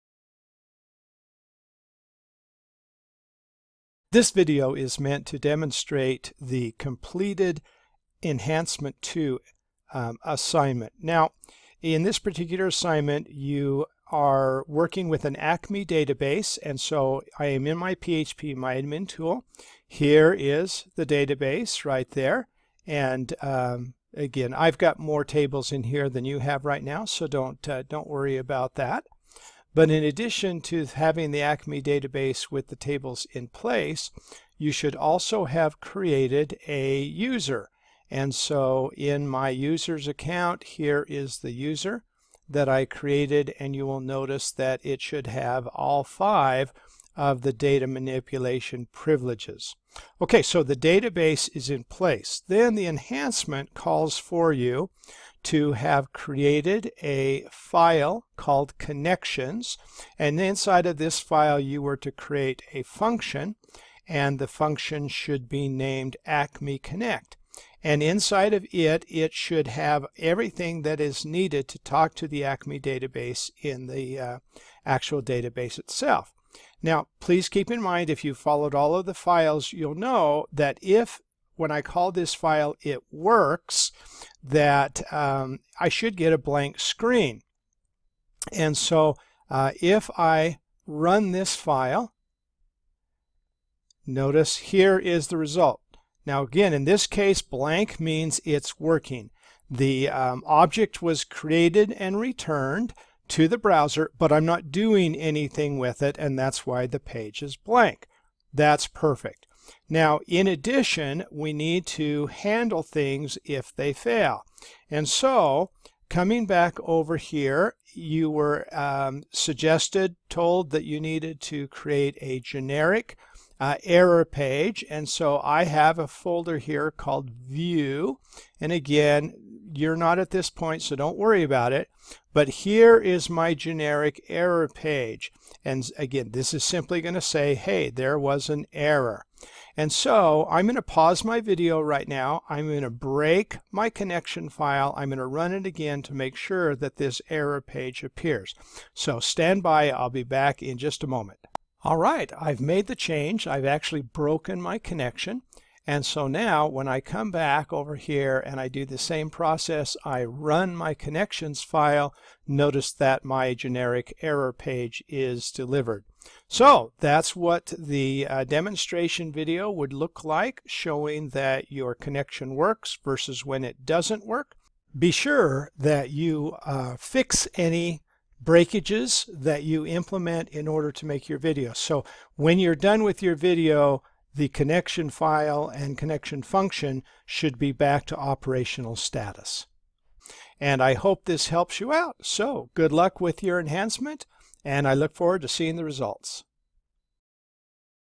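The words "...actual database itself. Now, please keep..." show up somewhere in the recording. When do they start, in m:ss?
1:14.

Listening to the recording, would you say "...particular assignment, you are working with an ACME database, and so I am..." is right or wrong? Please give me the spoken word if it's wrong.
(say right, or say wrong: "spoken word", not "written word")
right.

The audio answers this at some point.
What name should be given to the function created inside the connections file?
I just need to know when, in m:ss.
1:06.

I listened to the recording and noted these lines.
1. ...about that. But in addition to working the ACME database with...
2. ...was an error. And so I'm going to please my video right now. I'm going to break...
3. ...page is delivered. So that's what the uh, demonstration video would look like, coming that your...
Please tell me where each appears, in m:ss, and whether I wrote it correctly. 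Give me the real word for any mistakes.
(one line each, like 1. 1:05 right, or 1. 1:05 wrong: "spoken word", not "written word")
1. 0:28 wrong: "having", not "working"
2. 2:18 wrong: "pause", not "please"
3. 2:44 wrong: "showing", not "coming".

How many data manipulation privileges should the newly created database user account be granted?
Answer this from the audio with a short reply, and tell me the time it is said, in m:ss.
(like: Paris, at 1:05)
5, at 0:46.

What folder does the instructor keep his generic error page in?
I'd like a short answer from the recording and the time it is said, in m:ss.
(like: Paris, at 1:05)
View, at 2:07.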